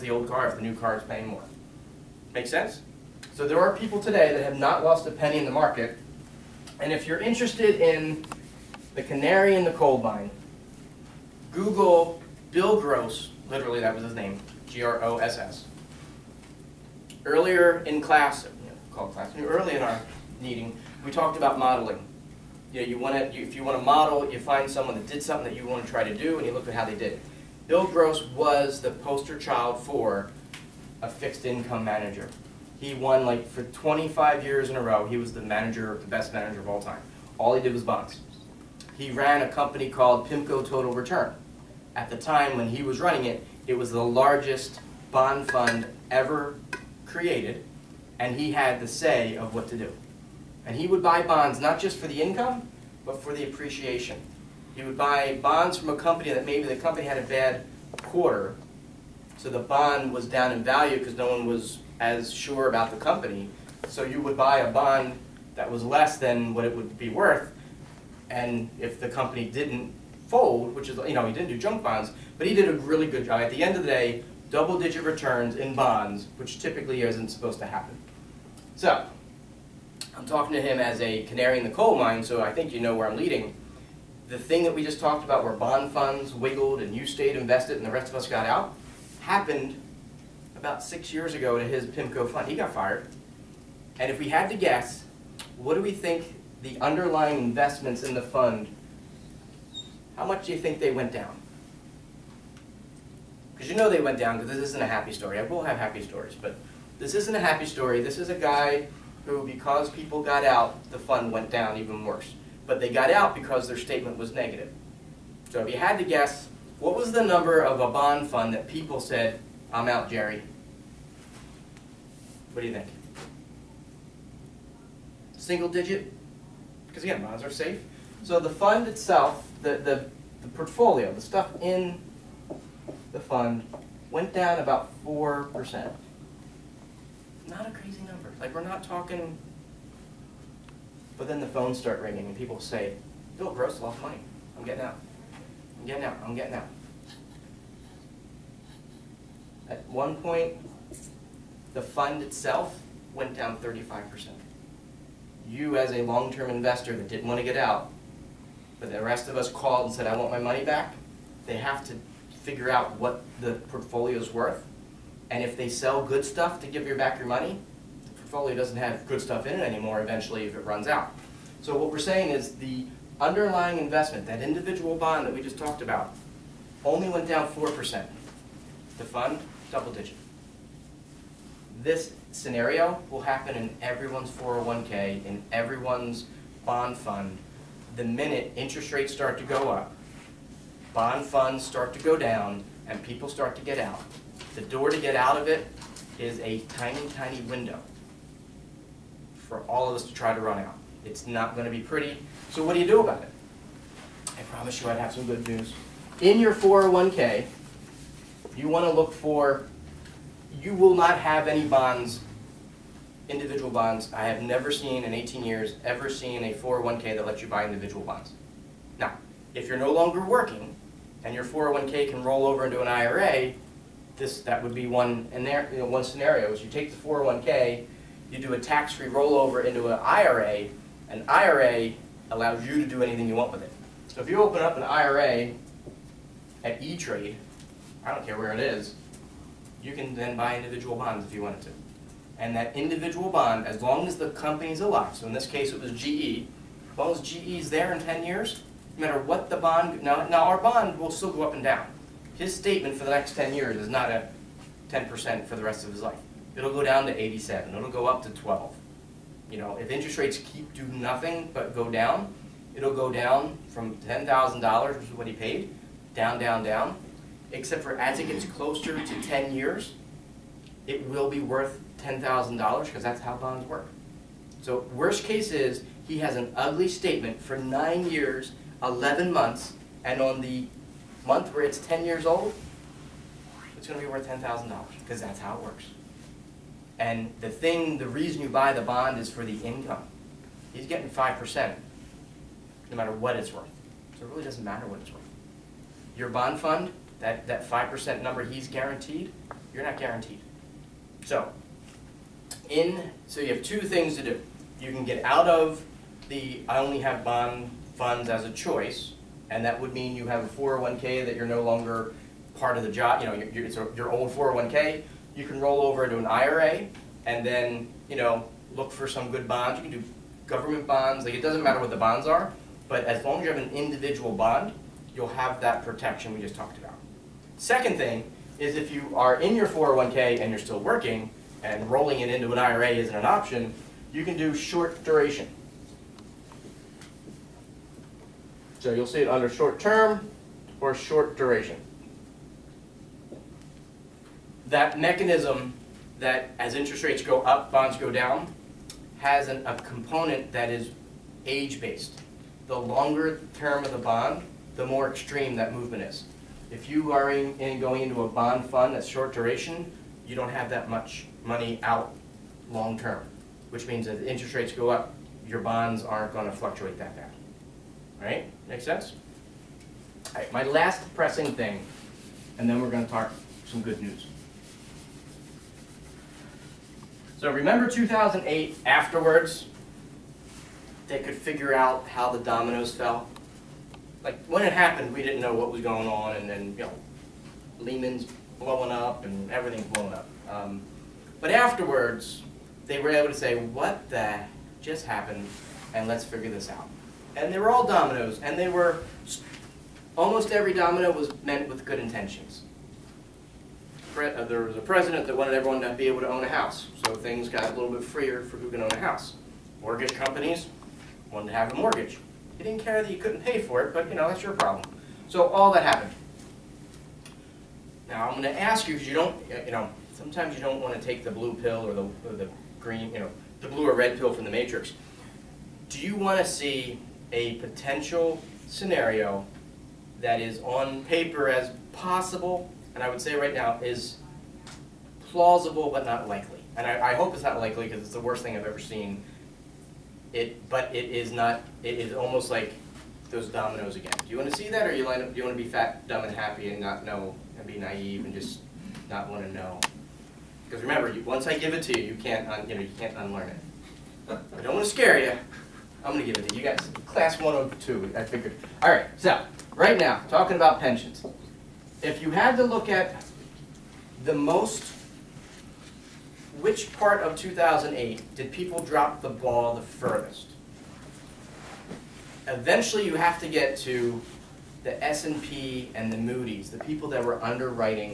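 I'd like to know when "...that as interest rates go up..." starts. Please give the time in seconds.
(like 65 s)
346 s.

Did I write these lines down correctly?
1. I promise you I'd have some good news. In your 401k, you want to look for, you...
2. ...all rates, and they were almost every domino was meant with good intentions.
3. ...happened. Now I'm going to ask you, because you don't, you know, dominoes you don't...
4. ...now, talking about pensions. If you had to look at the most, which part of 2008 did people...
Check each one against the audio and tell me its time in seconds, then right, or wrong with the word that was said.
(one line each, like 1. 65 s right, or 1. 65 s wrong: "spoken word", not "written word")
1. 204 s right
2. 397 s wrong: "dominoes", not "rates"
3. 415 s wrong: "sometimes", not "dominoes"
4. 459 s right.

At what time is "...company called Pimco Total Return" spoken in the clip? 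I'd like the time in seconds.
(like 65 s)
39 s.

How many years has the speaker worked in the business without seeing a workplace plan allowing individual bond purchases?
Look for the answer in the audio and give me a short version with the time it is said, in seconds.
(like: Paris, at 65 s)
18, at 215 s.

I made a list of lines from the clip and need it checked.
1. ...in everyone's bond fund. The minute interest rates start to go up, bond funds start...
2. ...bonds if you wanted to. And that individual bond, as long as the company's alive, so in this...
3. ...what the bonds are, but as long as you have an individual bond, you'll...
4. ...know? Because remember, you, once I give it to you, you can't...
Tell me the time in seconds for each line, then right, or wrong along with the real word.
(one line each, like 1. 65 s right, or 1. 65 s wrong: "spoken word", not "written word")
1. 185 s right
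2. 240 s right
3. 321 s right
4. 449 s right.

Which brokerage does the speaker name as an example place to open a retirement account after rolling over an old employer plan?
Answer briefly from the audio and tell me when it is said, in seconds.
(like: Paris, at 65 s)
E-Trade, at 236 s.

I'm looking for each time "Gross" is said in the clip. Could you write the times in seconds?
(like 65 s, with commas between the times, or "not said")
12 s, 27 s, 143 s.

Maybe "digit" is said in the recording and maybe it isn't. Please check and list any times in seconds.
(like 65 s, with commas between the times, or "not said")
74 s, 125 s, 179 s.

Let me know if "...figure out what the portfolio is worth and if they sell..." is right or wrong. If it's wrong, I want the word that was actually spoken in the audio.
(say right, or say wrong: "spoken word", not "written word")
right.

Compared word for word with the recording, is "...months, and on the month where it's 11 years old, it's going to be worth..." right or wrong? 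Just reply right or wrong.
wrong.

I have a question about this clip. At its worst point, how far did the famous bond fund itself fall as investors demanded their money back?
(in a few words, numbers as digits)
35%.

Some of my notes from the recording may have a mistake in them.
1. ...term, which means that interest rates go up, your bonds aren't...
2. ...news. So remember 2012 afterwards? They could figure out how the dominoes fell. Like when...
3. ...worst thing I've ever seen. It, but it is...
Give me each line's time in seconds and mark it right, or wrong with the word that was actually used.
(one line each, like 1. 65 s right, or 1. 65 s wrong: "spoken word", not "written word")
1. 362 s right
2. 374 s wrong: "2008", not "2012"
3. 438 s right.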